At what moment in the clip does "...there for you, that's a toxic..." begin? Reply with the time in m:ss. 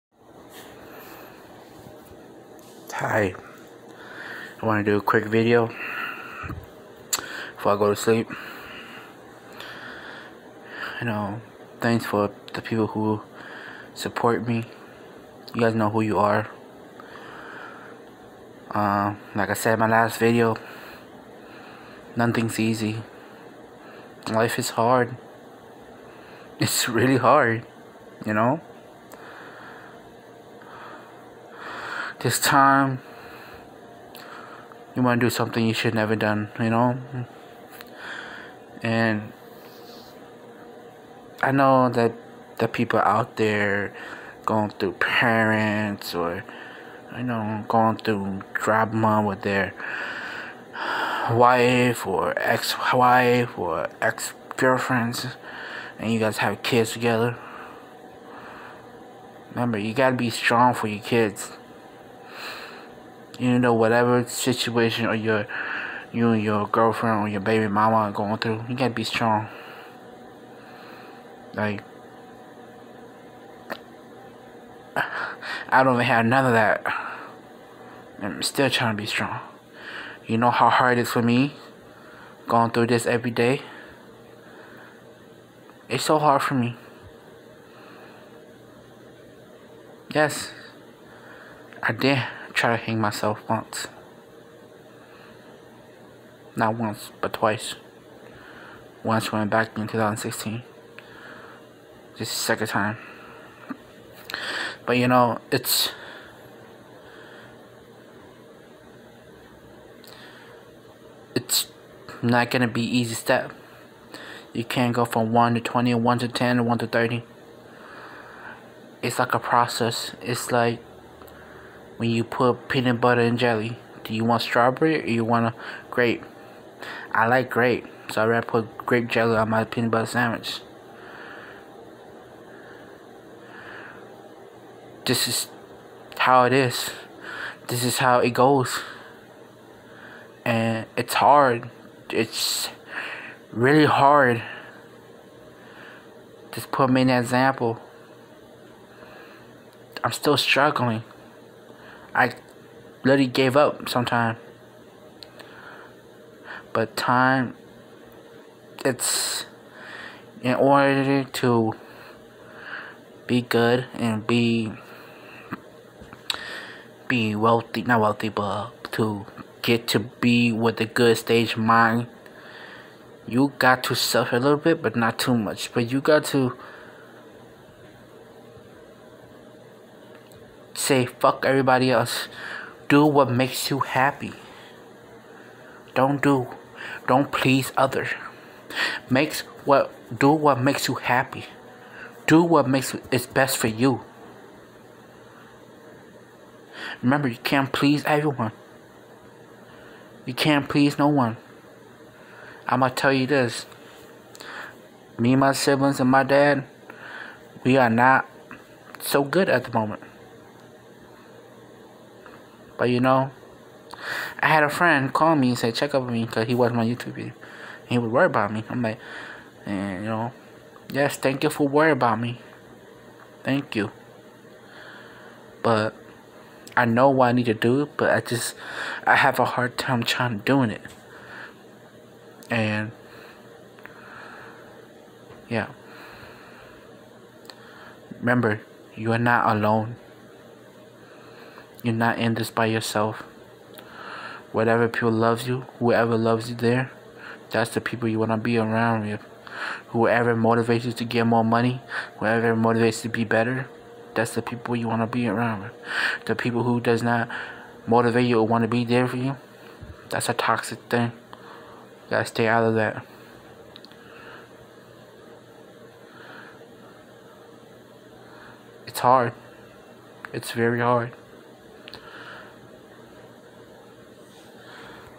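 4:18.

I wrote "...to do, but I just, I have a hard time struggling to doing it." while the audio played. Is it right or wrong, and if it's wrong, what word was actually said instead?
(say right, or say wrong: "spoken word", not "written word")
wrong: "trying", not "struggling".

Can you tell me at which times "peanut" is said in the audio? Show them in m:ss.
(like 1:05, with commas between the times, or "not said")
2:02, 2:09.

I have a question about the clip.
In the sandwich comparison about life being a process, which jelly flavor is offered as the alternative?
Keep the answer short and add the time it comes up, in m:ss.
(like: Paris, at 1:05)
Strawberry, at 2:04.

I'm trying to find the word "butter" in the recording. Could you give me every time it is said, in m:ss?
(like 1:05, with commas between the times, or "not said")
2:02, 2:09.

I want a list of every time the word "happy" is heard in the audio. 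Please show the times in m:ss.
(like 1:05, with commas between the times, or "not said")
3:03, 3:10.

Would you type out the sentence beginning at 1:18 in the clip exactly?
I'm still trying to be strong.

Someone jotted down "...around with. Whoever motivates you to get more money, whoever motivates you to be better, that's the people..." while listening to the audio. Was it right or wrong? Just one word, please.
right.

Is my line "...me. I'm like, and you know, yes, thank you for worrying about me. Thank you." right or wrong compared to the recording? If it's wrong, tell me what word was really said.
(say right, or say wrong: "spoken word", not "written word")
right.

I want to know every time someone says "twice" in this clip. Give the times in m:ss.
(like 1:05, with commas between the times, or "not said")
1:37.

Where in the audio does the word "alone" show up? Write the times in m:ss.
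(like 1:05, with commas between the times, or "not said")
3:59.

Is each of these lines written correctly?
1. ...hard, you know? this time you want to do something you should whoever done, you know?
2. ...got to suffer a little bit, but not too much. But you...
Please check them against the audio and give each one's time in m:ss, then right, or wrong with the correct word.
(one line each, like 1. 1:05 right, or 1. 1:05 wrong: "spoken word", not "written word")
1. 0:27 wrong: "never", not "whoever"
2. 2:53 right.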